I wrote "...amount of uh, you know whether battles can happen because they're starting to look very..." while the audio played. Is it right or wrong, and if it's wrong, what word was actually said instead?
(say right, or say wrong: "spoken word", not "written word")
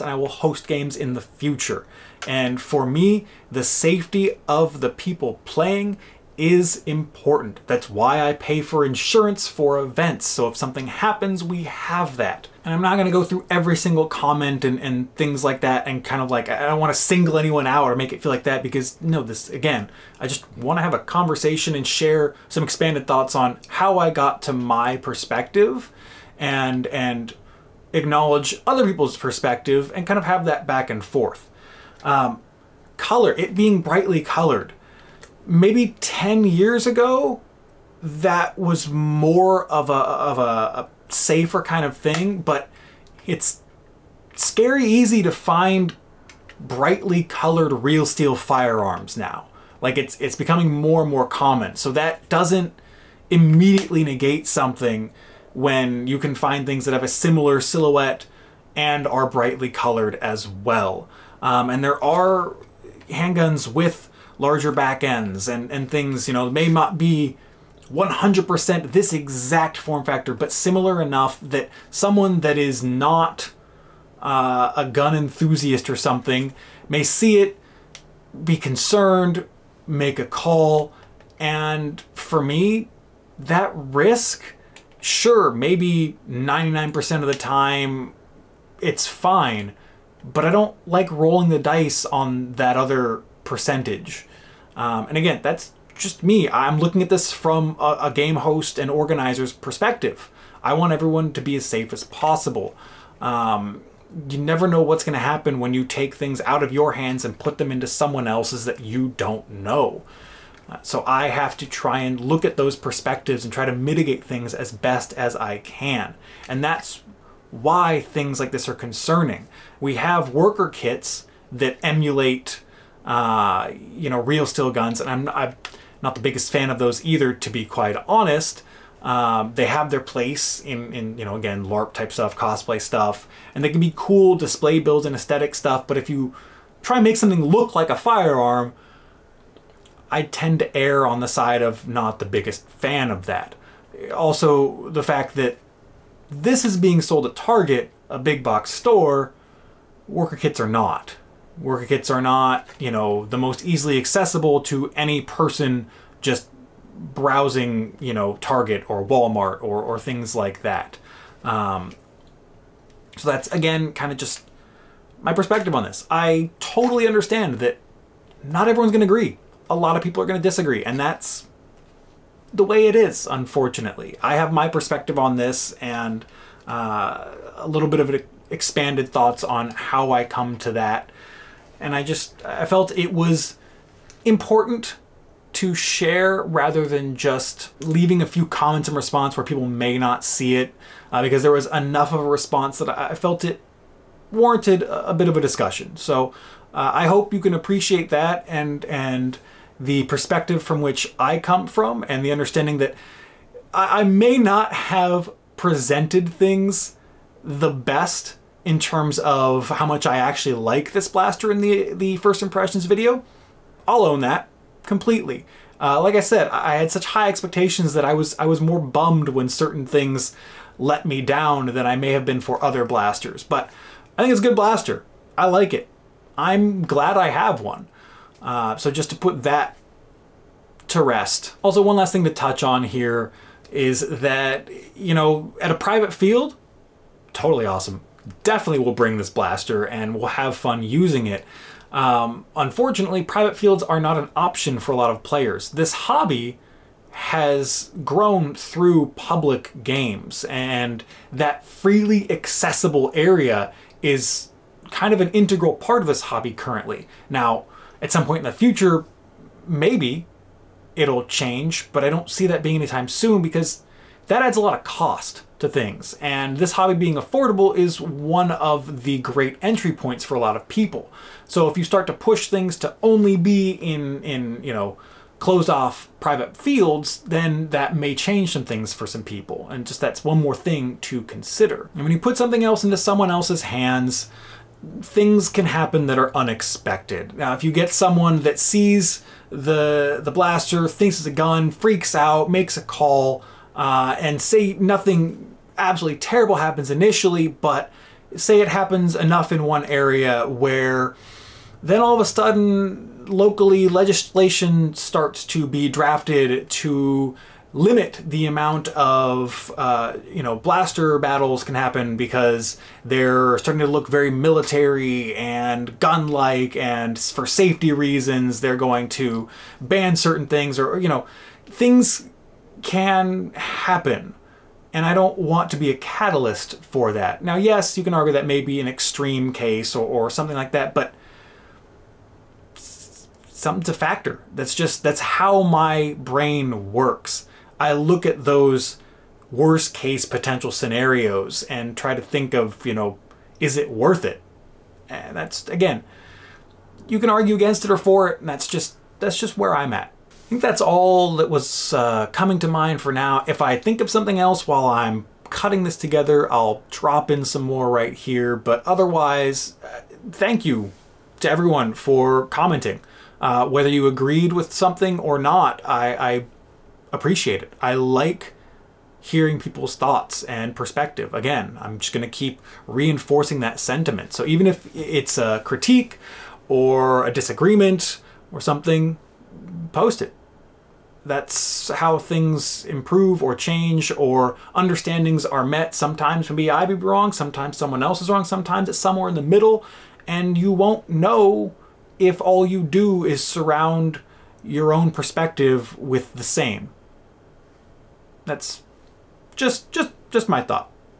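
wrong: "blaster", not "whether".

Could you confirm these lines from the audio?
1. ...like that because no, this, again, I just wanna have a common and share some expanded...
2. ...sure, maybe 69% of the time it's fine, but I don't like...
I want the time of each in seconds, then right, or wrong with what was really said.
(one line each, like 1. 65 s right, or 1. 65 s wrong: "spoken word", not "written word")
1. 18 s wrong: "conversation", not "common"
2. 85 s wrong: "99", not "69".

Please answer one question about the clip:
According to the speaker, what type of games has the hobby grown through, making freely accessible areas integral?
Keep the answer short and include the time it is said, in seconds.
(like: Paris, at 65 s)
Public games, at 249 s.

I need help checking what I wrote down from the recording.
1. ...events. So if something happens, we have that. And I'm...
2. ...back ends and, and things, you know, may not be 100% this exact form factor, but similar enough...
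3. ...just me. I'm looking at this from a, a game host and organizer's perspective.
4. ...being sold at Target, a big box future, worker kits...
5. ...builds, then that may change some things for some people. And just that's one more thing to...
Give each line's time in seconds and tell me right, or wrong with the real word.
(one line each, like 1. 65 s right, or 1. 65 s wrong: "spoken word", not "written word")
1. 9 s right
2. 64 s right
3. 95 s right
4. 146 s wrong: "store", not "future"
5. 276 s wrong: "fields", not "builds".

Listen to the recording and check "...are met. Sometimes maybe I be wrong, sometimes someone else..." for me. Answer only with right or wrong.
right.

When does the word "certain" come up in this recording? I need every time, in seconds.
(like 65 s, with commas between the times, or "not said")
219 s, 320 s.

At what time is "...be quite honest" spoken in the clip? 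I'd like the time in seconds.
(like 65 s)
127 s.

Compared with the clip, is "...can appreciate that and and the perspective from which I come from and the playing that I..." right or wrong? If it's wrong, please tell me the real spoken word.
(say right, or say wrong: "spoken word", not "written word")
wrong: "understanding", not "playing".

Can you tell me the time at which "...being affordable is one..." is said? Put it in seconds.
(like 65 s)
266 s.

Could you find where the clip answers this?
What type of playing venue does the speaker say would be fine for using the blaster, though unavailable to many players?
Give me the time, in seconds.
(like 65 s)
235 s.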